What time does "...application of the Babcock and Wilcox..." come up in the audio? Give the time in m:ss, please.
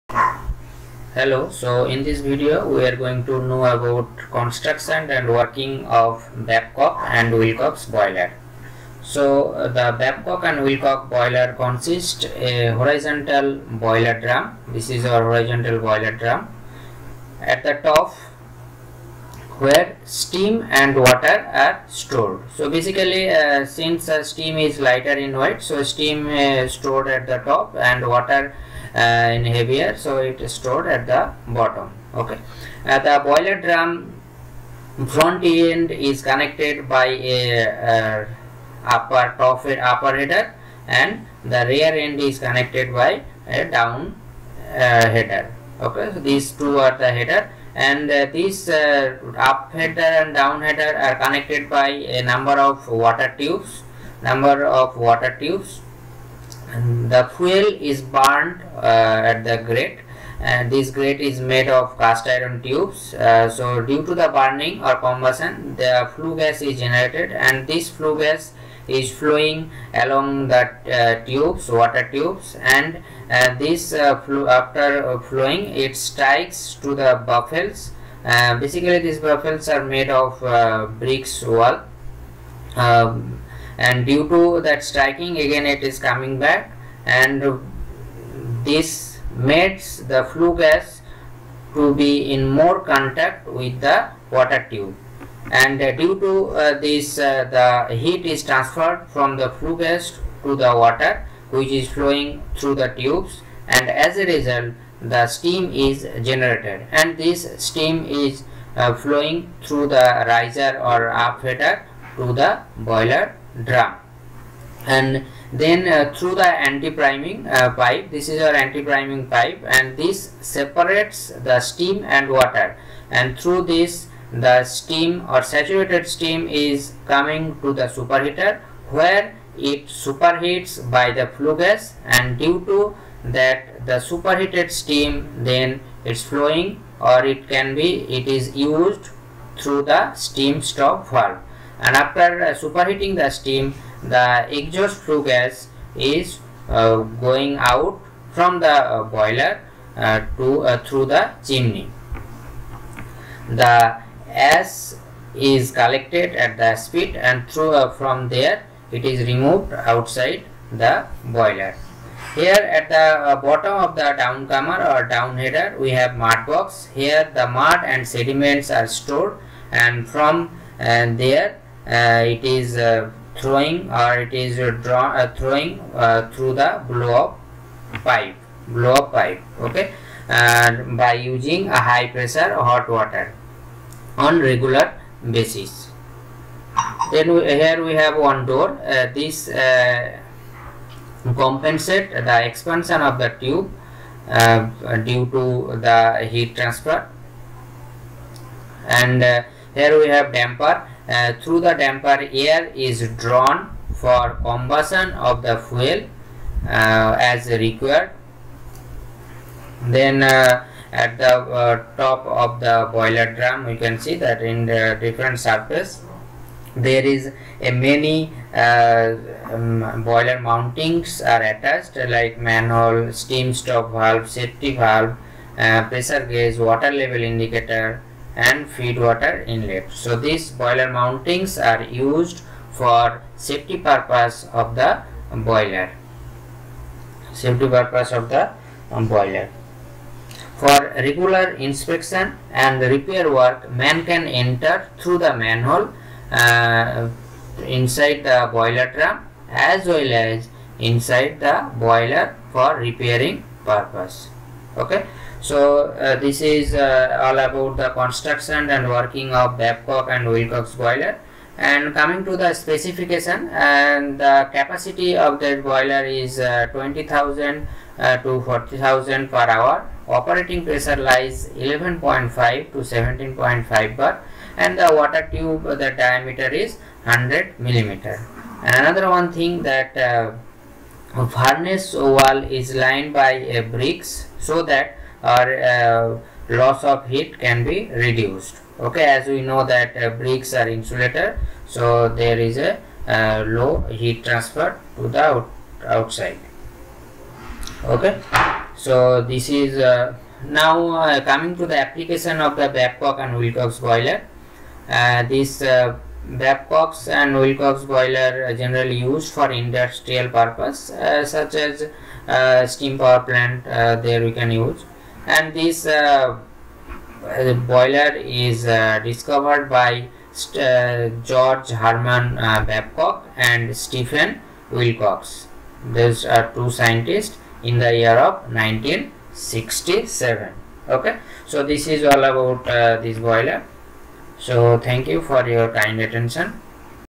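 5:01.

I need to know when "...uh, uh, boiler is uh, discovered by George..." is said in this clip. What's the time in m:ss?
5:15.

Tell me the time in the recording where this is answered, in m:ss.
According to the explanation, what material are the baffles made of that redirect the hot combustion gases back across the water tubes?
1:20.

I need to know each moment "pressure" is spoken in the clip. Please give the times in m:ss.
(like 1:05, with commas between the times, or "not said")
3:02, 3:45, 4:30.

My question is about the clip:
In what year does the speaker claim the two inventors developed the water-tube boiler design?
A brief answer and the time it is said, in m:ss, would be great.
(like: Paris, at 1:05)
1967, at 5:28.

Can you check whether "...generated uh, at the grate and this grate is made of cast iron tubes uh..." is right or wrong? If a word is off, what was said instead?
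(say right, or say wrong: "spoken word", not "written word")
wrong: "burned", not "generated".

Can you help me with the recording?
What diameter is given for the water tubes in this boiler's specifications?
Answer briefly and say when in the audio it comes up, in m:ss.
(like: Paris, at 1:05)
100 millimeter, at 4:37.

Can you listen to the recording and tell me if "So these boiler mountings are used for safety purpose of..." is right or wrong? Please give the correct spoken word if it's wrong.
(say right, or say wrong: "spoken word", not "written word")
right.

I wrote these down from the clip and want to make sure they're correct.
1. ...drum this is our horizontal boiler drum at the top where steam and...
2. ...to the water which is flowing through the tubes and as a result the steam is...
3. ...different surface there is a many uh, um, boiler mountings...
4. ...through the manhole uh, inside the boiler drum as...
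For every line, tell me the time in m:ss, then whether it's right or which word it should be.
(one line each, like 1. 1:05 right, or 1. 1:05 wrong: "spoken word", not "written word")
1. 0:14 right
2. 1:40 right
3. 3:35 right
4. 4:04 right.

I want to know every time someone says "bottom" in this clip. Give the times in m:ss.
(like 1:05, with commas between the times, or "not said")
0:31, 2:43.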